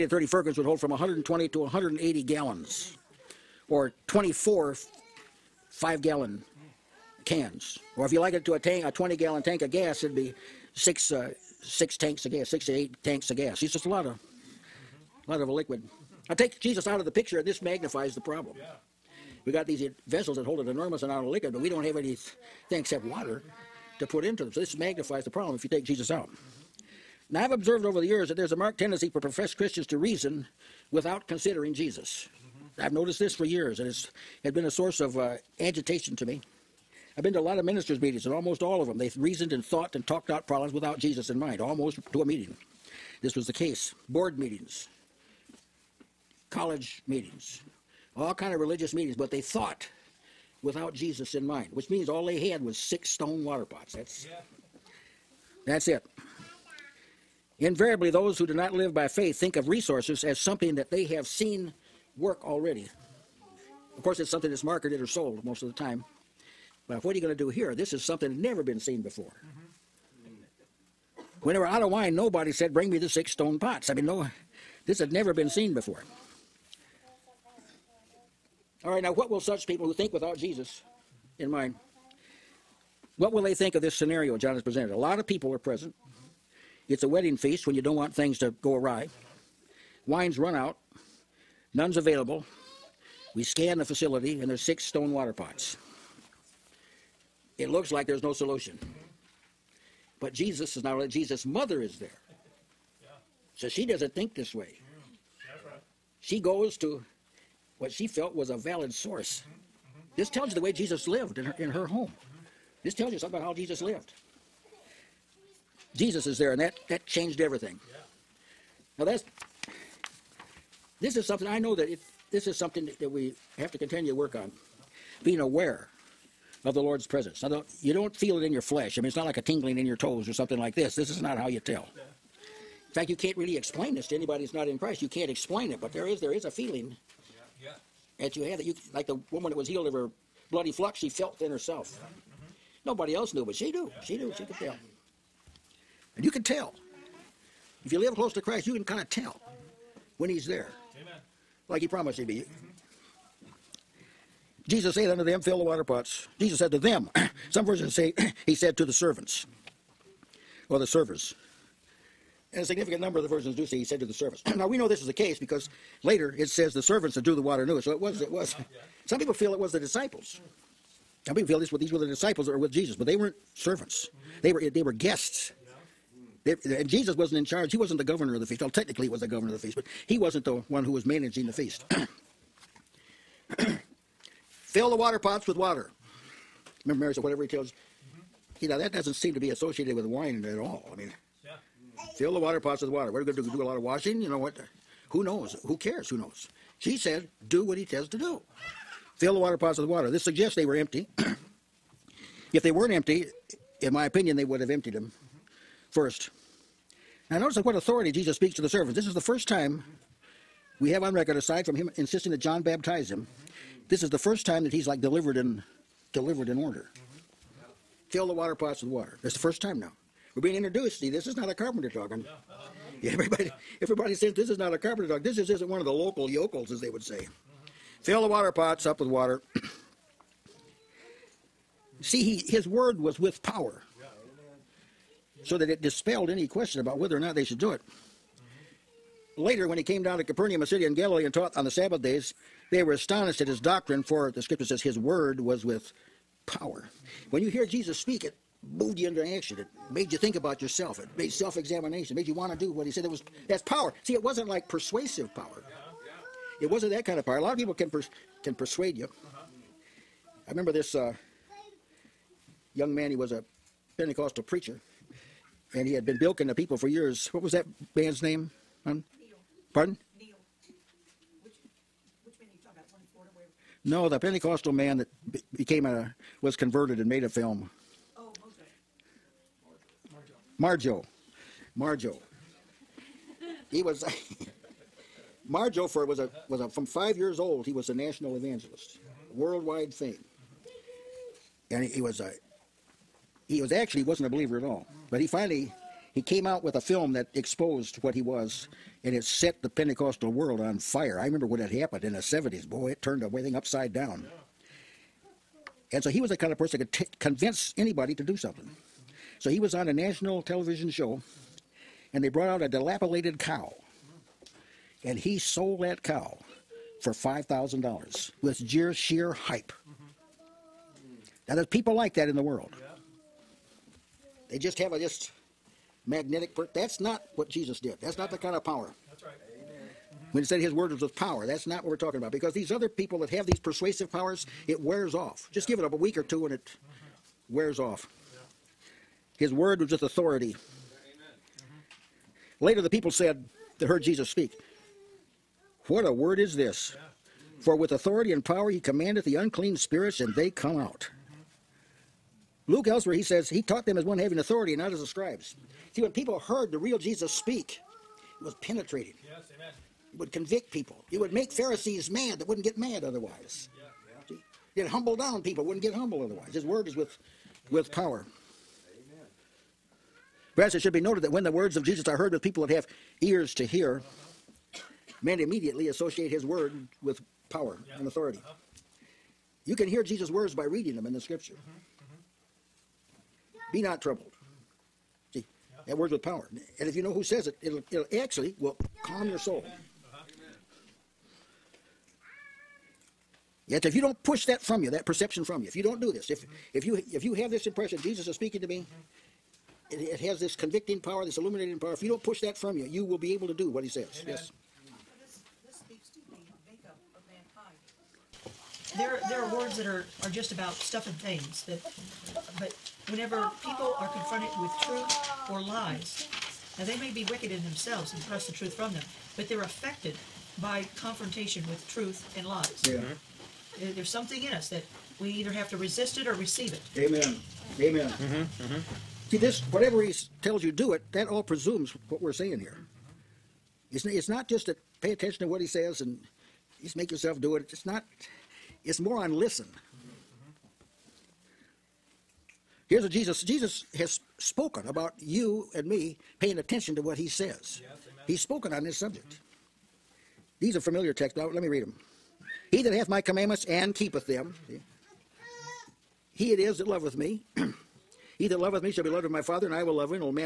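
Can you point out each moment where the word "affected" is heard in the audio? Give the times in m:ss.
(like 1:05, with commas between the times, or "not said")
6:59.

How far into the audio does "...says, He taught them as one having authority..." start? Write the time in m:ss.
5:53.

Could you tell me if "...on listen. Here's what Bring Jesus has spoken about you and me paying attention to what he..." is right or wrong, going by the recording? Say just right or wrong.
wrong.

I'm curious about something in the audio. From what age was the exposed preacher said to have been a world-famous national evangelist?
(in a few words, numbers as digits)
5.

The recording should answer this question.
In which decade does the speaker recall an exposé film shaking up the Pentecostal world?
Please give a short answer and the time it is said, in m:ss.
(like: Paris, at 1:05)
the 70s, at 5:02.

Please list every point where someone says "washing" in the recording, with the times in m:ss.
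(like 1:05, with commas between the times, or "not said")
3:13.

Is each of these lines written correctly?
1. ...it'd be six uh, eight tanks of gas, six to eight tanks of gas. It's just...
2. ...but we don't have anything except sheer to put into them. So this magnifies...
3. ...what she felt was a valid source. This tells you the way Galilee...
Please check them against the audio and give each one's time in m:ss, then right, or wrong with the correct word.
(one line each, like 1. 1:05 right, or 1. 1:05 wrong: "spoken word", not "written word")
1. 0:10 wrong: "six", not "eight"
2. 0:21 wrong: "water", not "sheer"
3. 1:47 wrong: "Jesus", not "Galilee".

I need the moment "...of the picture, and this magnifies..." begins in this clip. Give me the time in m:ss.
0:16.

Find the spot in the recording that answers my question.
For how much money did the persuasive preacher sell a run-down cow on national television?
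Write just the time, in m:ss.
5:17.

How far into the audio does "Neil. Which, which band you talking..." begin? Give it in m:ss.
4:30.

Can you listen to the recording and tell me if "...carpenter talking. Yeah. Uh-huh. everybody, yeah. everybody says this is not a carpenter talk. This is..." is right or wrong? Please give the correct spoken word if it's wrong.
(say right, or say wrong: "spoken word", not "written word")
right.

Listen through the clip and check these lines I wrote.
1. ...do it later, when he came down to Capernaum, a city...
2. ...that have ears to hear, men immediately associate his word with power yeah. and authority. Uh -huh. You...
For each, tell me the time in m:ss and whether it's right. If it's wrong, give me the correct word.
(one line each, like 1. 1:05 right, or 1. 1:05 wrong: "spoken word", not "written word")
1. 3:57 right
2. 6:12 right.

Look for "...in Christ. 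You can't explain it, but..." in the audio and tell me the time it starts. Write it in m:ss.
2:14.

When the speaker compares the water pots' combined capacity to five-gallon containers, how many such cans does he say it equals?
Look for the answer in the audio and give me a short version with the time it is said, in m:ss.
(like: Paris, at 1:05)
24, at 0:04.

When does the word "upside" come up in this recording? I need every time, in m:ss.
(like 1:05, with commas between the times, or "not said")
5:03.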